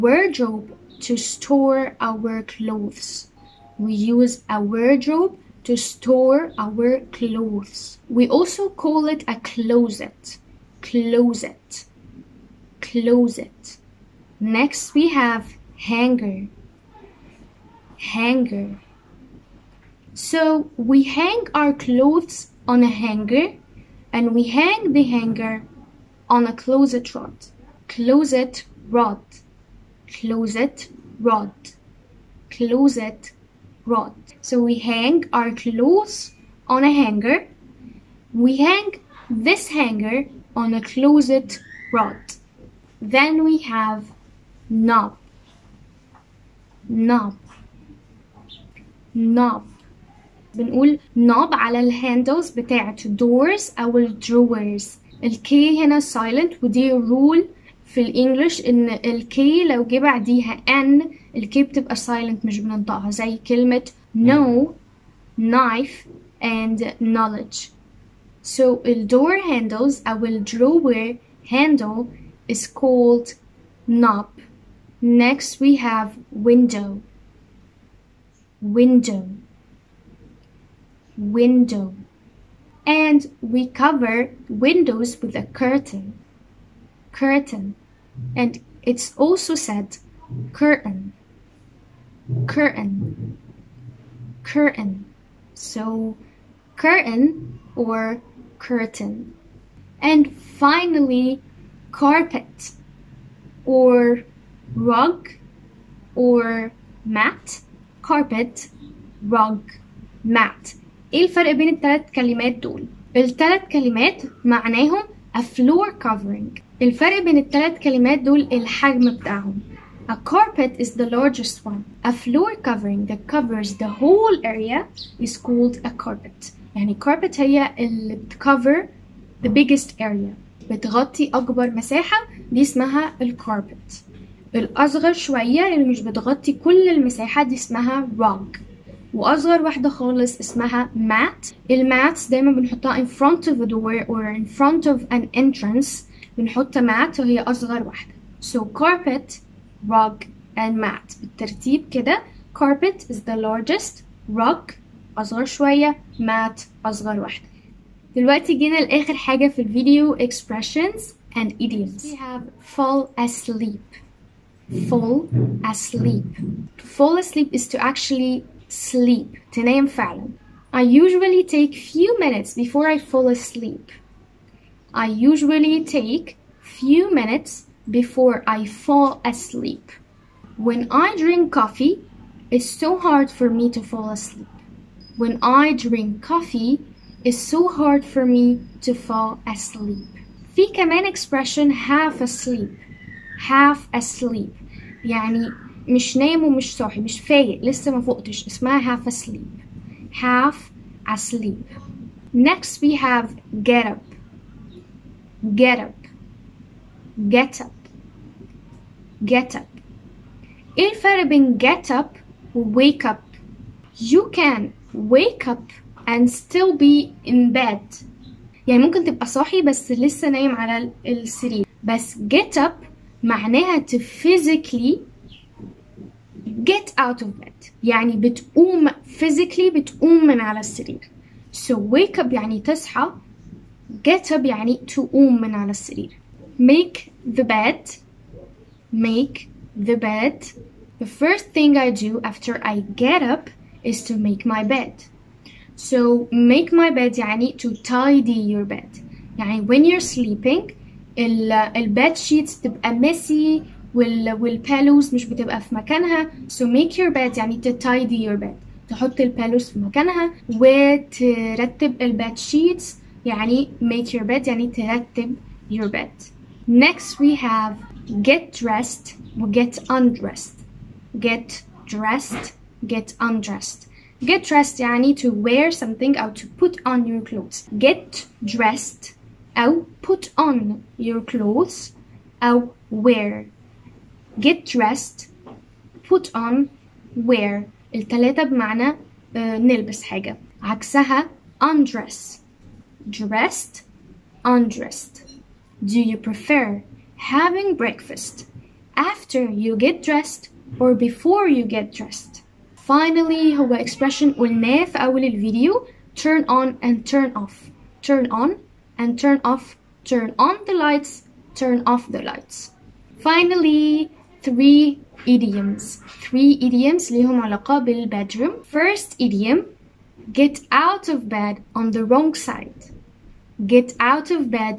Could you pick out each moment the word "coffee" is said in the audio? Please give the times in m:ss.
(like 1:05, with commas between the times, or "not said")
3:01, 3:06.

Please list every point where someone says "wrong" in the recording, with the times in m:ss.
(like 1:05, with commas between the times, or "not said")
5:22.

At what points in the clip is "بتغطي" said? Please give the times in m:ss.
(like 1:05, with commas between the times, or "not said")
2:10, 2:16.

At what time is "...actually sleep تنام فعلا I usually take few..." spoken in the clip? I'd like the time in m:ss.
2:47.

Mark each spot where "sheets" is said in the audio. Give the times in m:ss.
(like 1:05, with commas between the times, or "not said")
4:12, 4:22.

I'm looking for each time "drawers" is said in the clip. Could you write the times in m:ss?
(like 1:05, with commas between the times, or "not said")
0:54, 1:10.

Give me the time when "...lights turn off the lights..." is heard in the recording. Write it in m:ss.
5:10.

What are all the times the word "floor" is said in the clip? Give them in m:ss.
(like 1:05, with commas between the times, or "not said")
1:55, 2:02.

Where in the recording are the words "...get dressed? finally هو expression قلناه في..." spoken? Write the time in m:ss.
5:01.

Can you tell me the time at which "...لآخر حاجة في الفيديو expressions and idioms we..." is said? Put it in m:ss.
2:38.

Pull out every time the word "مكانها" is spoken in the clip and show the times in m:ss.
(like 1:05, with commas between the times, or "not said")
4:15, 4:19.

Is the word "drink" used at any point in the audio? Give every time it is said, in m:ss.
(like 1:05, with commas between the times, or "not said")
3:01, 3:05.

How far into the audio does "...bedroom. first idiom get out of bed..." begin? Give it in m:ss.
5:18.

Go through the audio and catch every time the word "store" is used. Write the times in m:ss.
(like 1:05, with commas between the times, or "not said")
0:01, 0:05.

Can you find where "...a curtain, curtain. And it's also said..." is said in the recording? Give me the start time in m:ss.
1:25.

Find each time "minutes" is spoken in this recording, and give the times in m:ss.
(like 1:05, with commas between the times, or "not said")
2:52, 2:57.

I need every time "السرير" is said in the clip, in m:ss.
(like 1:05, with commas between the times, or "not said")
3:41, 3:50, 3:55.